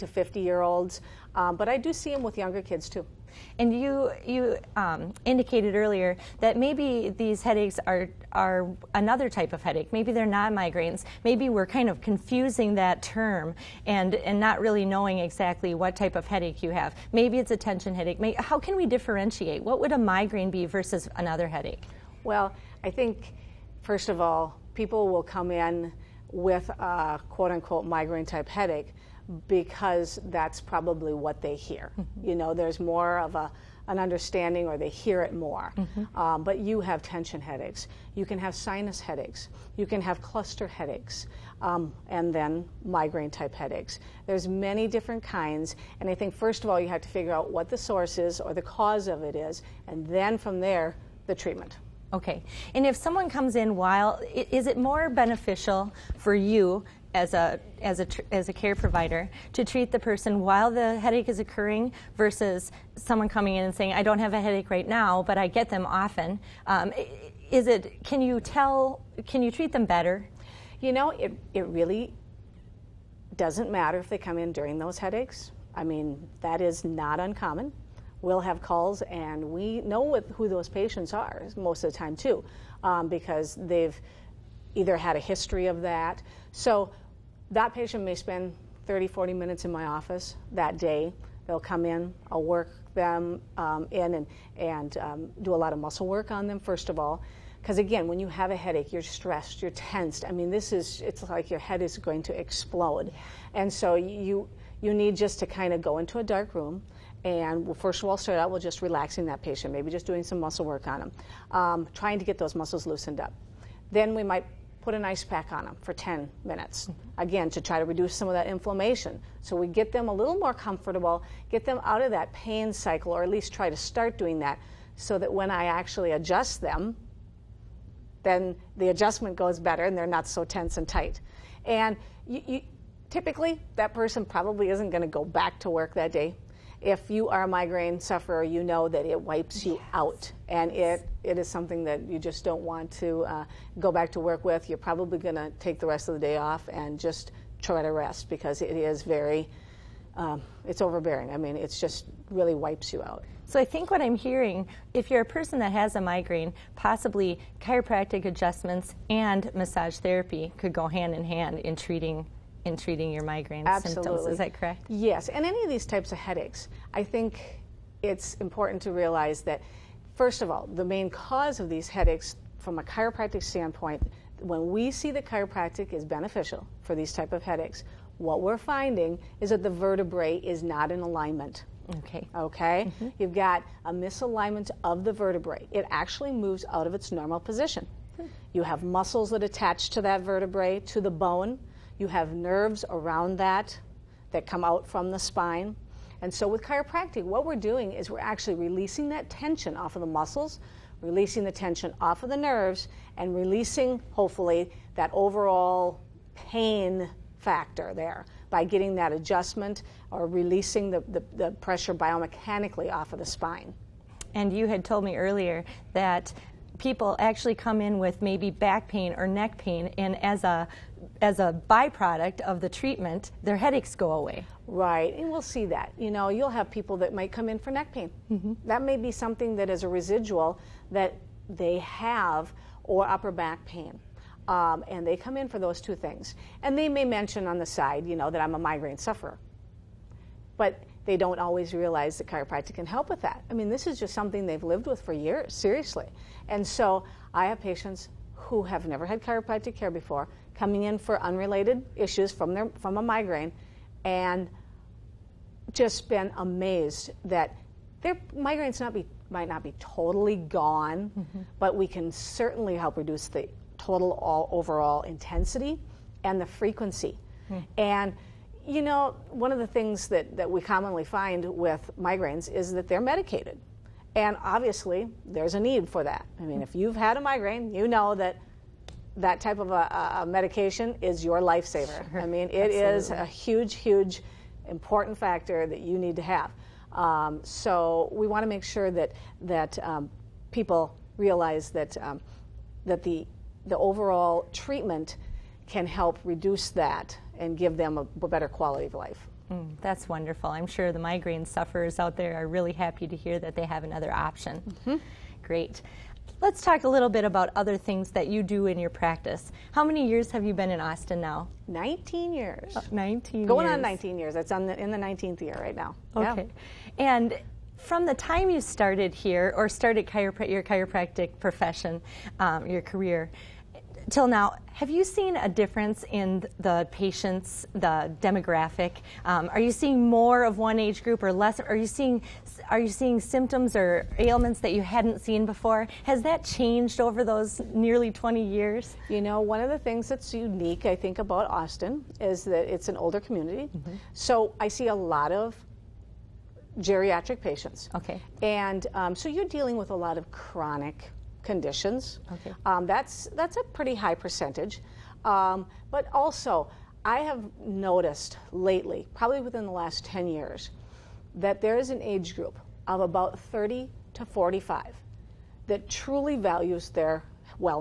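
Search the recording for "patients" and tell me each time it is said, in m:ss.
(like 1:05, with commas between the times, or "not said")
1:20, 1:27, 1:49, 4:07, 5:26, 5:47.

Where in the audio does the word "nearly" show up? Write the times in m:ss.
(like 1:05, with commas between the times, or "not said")
5:37.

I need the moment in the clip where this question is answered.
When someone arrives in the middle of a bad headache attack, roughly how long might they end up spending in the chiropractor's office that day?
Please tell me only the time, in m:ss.
1:28.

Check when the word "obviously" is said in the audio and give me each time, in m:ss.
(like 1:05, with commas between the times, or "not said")
4:34.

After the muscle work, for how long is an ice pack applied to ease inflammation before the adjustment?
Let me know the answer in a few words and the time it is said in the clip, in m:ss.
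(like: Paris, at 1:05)
10 minutes, at 1:55.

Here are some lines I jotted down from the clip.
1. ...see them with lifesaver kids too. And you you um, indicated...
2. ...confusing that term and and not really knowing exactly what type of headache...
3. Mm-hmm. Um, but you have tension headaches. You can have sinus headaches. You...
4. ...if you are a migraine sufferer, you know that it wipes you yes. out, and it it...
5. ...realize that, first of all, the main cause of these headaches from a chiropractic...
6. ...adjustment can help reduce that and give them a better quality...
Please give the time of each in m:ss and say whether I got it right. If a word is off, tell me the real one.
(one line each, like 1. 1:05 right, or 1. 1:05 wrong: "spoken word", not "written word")
1. 0:01 wrong: "younger", not "lifesaver"
2. 0:12 right
3. 0:35 right
4. 2:16 right
5. 2:48 right
6. 4:54 wrong: "treatment", not "adjustment".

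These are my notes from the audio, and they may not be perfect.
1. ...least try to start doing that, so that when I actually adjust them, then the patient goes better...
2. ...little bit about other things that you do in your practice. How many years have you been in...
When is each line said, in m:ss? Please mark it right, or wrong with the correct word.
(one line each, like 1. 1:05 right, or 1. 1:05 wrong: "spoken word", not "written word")
1. 2:03 wrong: "adjustment", not "patient"
2. 5:06 right.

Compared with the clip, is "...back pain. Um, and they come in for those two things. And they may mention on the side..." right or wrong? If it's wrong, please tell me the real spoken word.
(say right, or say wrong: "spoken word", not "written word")
right.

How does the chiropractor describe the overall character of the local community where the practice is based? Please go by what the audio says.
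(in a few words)
an older community.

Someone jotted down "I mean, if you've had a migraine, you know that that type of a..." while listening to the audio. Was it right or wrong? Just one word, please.
right.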